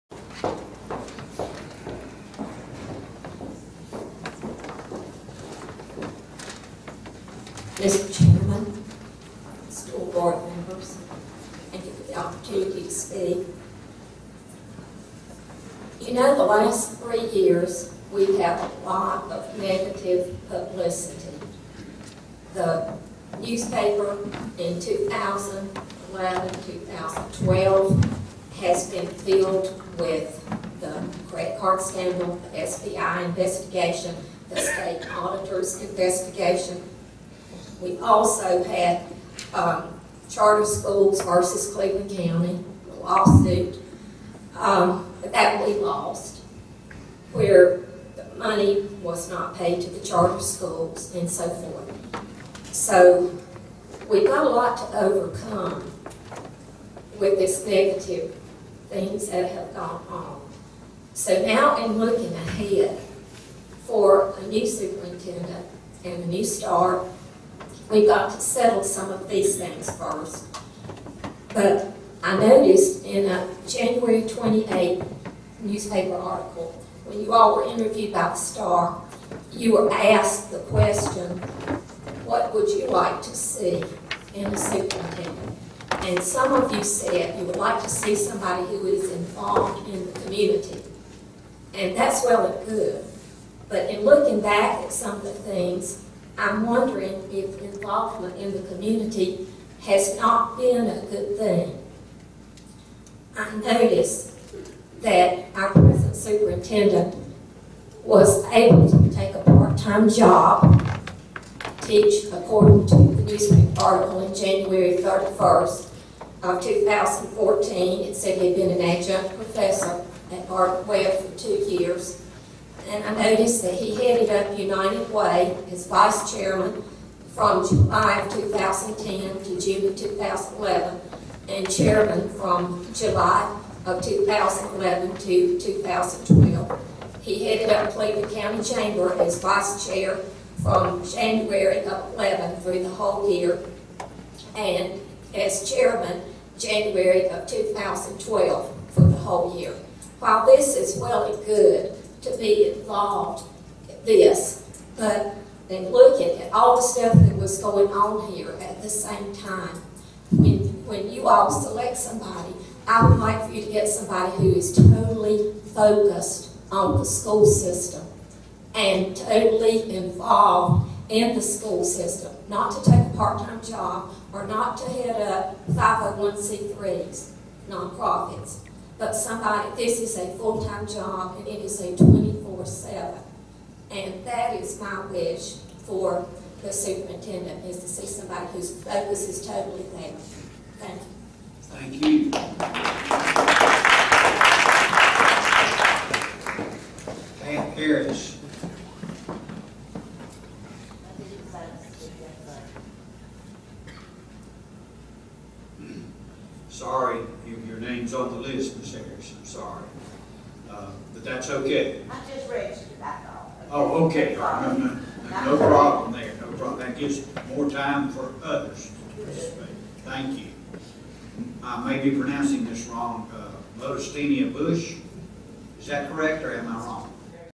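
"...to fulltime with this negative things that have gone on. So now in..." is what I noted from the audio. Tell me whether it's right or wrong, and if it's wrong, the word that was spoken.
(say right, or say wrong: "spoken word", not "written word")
wrong: "overcome", not "fulltime".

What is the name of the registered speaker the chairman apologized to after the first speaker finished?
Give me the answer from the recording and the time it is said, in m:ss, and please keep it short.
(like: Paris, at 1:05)
Ms. Harris, at 3:28.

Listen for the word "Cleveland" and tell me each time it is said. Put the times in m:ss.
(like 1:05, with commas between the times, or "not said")
0:41, 2:17.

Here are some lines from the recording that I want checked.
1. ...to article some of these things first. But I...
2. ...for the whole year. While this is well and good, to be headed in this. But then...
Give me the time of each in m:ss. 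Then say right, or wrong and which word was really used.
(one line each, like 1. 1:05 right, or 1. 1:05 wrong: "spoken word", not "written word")
1. 1:08 wrong: "settle", not "article"
2. 2:28 wrong: "involved", not "headed".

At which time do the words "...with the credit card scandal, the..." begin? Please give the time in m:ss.
0:29.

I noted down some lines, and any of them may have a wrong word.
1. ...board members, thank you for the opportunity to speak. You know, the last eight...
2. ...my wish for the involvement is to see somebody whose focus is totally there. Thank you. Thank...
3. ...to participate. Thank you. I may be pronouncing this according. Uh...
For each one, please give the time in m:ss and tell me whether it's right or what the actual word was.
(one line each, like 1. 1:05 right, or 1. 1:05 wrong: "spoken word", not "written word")
1. 0:10 wrong: "three", not "eight"
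2. 3:04 wrong: "superintendent", not "involvement"
3. 3:39 wrong: "wrong", not "according".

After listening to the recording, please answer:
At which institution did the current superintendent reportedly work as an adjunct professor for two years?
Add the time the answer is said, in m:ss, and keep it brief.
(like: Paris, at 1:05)
Gardner-Webb, at 2:00.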